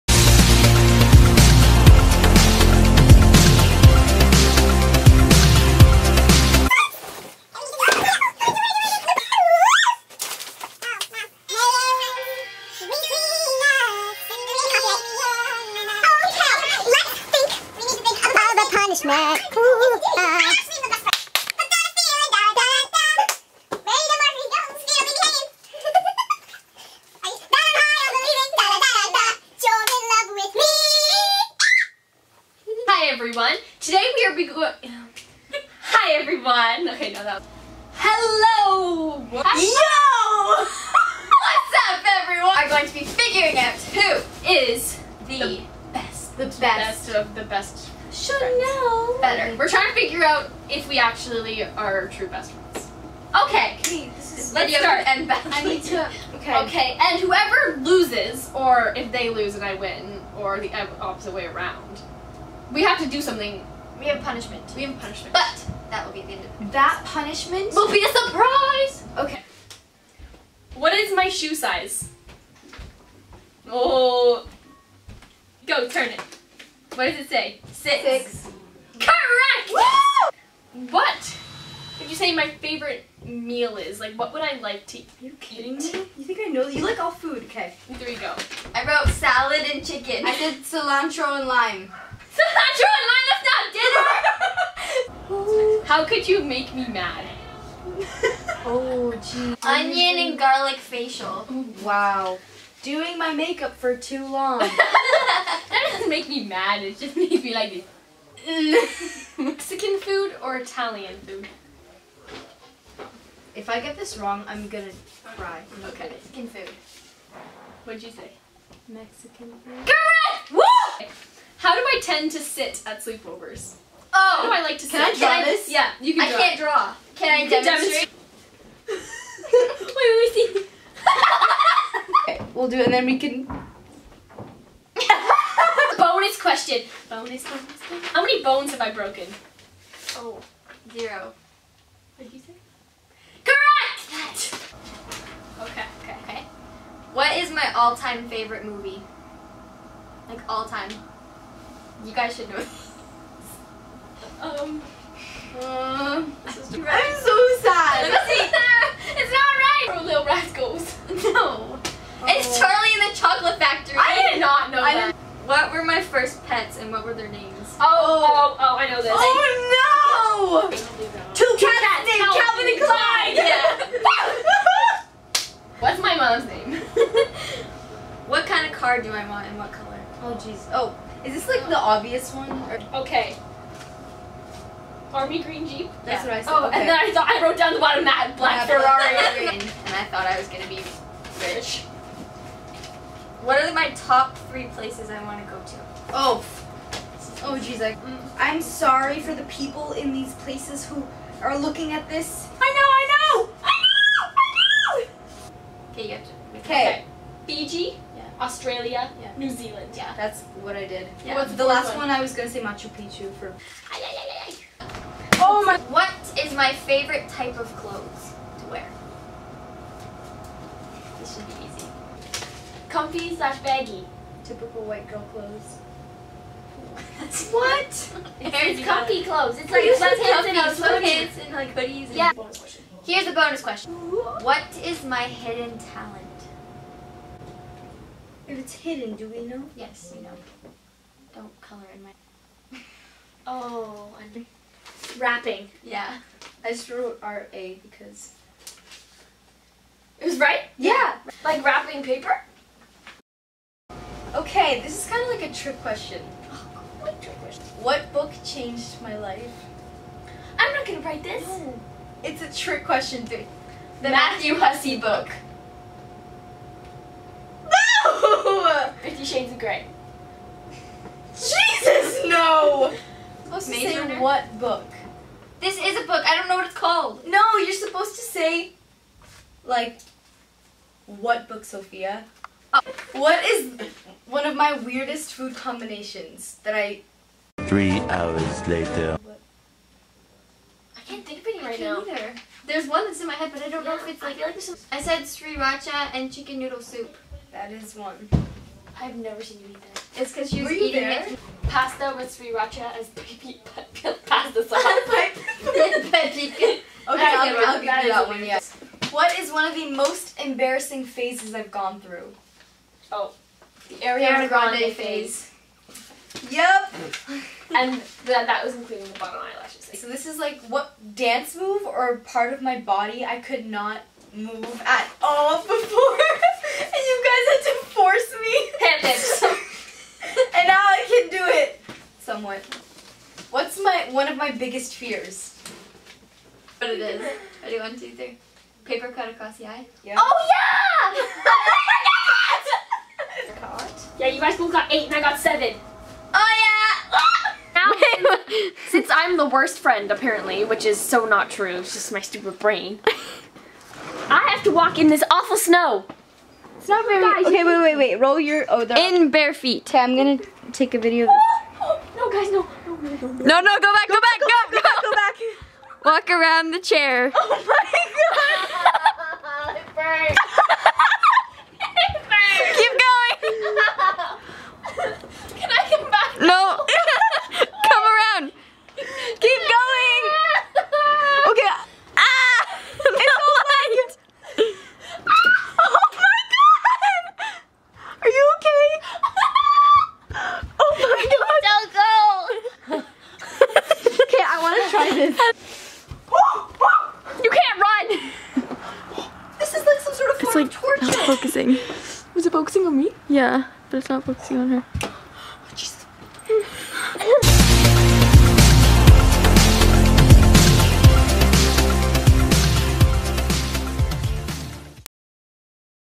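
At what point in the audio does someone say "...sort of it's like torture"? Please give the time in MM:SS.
06:40.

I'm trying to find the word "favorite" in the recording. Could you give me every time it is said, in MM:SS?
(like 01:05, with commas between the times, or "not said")
01:22, 02:28, 03:36.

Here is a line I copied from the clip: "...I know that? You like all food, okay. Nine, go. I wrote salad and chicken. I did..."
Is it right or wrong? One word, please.
wrong.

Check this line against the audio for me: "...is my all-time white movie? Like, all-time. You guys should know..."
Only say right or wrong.
wrong.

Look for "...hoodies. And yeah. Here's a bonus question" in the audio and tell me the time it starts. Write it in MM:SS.
03:51.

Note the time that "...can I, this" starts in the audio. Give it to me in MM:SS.
02:05.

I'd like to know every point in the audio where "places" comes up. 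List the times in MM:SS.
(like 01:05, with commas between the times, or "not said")
03:14, 03:20.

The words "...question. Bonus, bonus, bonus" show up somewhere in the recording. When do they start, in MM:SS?
02:16.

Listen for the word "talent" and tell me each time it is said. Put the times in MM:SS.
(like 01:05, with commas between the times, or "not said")
03:55.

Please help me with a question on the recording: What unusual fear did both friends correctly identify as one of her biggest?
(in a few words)
Paper cut across the eye.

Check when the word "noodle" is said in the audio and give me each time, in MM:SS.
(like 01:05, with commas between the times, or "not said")
04:56.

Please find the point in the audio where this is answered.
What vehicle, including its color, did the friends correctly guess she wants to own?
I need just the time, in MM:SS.
03:05.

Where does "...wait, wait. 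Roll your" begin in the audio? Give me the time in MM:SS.
05:57.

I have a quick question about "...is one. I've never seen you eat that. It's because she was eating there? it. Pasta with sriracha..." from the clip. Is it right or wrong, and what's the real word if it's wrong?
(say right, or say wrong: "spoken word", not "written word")
right.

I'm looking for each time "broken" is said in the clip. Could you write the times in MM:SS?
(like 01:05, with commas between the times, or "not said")
02:18.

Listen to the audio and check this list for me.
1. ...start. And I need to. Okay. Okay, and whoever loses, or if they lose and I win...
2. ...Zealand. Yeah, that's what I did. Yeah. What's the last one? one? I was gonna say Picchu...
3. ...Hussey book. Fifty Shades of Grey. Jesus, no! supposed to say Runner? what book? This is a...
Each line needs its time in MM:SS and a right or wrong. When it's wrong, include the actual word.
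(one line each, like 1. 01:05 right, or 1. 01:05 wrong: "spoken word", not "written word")
1. 00:54 right
2. 03:29 wrong: "Machu", not "Picchu"
3. 04:24 right.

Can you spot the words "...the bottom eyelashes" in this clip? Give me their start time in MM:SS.
05:19.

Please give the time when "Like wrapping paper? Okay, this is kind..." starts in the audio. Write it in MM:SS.
04:11.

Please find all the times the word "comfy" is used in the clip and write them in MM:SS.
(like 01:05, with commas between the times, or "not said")
03:42, 03:48.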